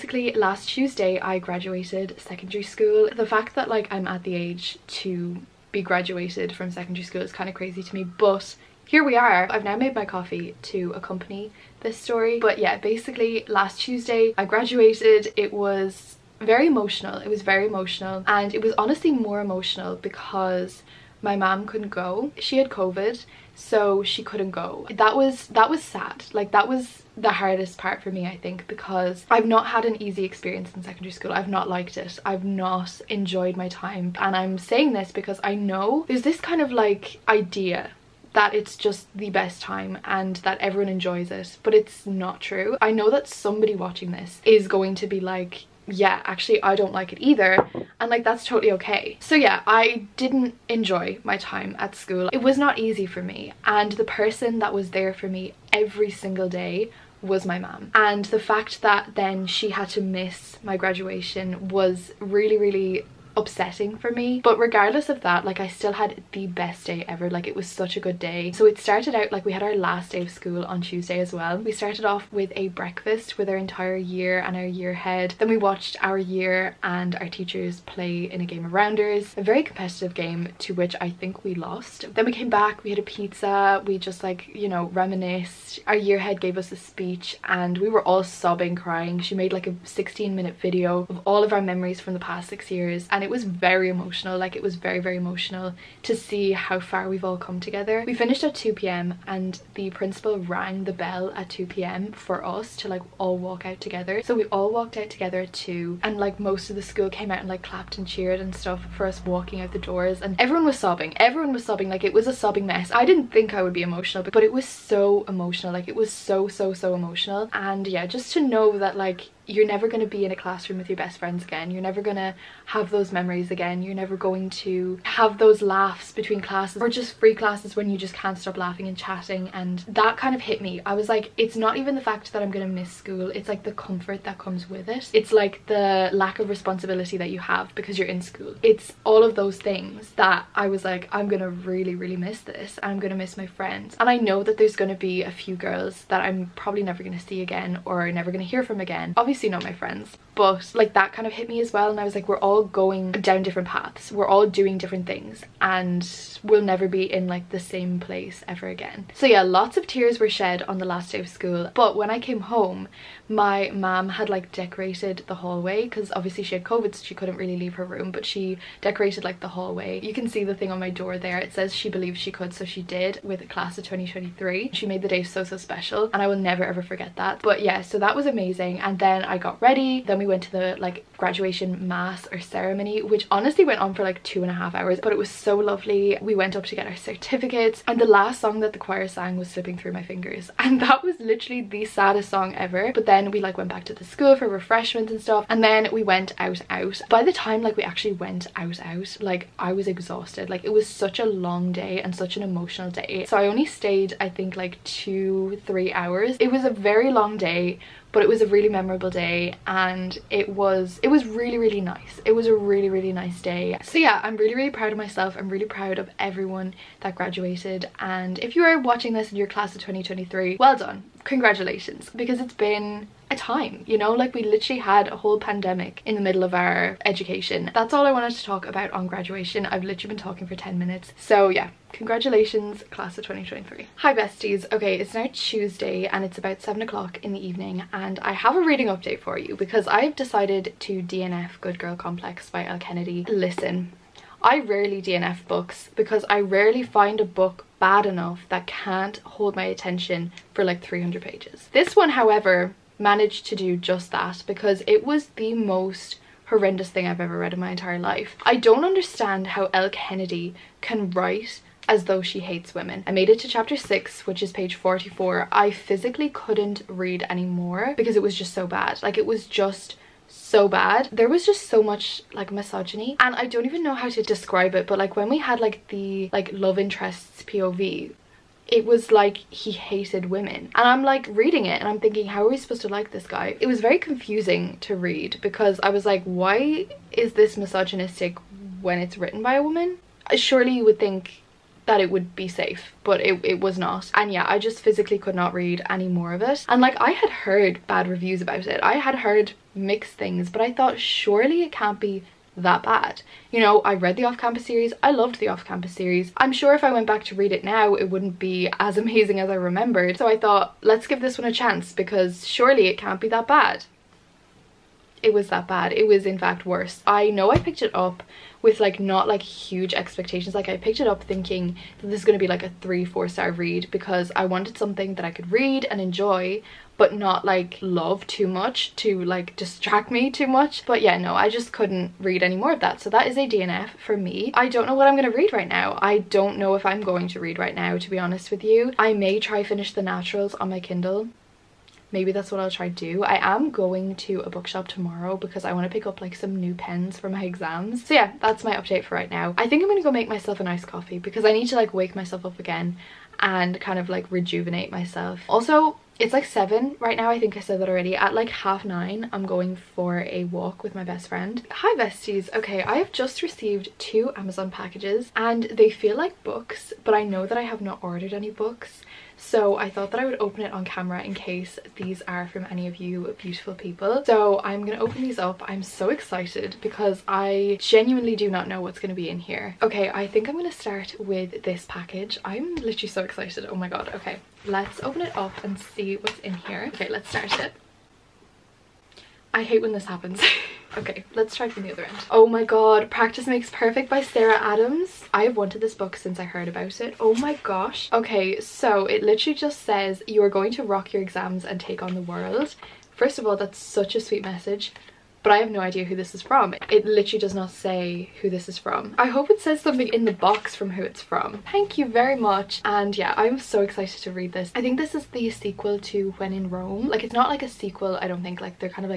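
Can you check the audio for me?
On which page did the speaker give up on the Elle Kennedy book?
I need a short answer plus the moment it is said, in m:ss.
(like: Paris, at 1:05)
44, at 4:24.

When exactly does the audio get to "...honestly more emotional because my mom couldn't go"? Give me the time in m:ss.
0:18.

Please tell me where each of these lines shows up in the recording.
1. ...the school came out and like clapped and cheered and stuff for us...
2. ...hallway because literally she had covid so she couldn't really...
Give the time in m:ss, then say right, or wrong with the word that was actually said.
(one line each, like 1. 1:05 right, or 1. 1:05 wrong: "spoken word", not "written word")
1. 1:46 right
2. 2:45 wrong: "obviously", not "literally".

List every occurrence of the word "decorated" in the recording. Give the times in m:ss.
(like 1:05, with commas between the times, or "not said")
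2:44, 2:48.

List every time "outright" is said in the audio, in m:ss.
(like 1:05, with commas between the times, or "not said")
not said.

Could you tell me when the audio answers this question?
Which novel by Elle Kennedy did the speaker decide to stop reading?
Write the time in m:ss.
4:01.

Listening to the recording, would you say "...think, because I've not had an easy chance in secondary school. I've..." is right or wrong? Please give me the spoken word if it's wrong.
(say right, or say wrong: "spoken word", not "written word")
wrong: "experience", not "chance".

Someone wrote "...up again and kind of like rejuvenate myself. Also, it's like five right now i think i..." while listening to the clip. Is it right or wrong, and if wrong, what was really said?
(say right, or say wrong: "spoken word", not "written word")
wrong: "seven", not "five".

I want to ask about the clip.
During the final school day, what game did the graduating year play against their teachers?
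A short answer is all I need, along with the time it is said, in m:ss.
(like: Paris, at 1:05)
rounders, at 1:18.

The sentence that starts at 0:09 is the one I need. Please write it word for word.
I've now made my coffee to accompany this story.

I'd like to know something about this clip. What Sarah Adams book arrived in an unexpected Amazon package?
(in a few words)
Practice Makes Perfect.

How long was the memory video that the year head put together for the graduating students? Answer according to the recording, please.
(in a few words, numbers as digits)
16 minutes.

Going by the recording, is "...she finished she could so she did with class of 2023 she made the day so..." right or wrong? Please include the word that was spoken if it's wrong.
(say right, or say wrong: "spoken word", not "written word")
wrong: "believed", not "finished".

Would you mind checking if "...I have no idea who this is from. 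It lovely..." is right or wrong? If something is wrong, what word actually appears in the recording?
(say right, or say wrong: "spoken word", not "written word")
wrong: "literally", not "lovely".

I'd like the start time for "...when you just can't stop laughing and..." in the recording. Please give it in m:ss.
2:07.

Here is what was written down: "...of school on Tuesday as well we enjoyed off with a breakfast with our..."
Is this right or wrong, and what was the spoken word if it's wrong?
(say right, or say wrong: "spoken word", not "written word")
wrong: "started", not "enjoyed".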